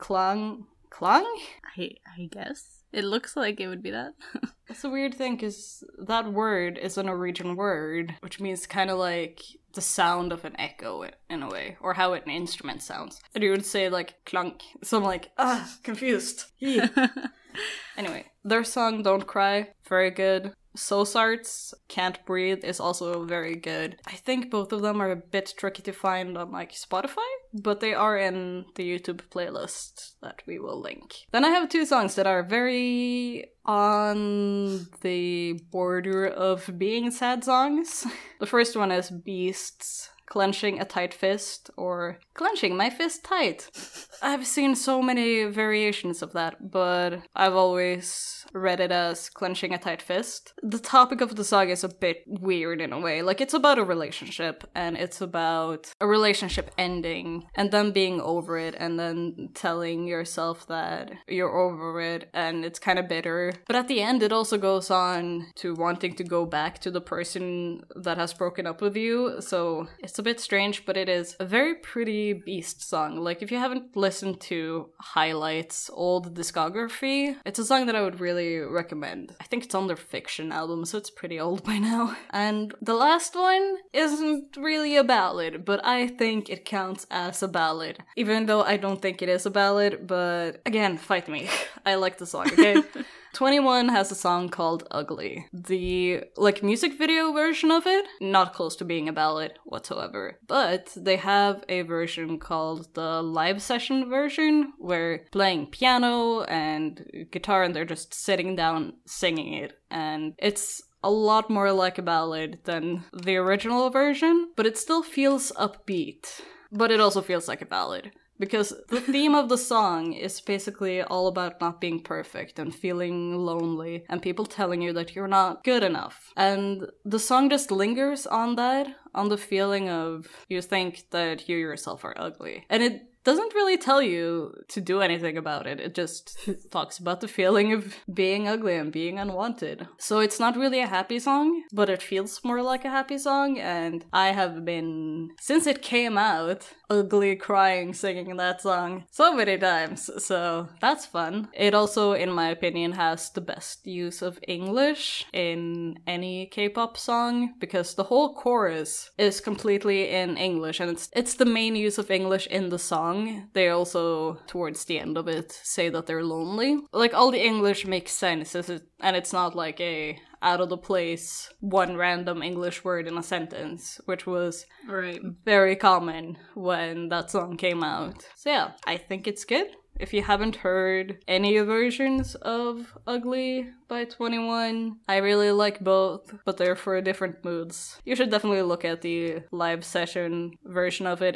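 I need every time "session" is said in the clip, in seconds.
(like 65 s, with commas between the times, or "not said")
103 s, 189 s.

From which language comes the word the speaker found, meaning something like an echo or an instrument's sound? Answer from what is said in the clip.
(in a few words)
Norwegian.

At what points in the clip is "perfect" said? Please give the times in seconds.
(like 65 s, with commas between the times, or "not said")
122 s.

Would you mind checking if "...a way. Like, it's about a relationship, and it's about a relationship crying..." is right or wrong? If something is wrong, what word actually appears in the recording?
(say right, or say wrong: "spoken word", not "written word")
wrong: "ending", not "crying".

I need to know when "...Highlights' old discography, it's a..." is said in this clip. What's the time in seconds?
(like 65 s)
75 s.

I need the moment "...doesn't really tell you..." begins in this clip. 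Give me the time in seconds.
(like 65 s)
133 s.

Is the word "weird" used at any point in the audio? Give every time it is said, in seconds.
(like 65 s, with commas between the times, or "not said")
4 s, 52 s.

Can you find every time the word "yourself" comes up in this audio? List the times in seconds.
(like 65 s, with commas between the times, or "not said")
60 s, 131 s.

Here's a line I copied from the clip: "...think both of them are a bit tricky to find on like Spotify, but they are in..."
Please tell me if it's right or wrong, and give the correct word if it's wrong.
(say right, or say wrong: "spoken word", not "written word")
right.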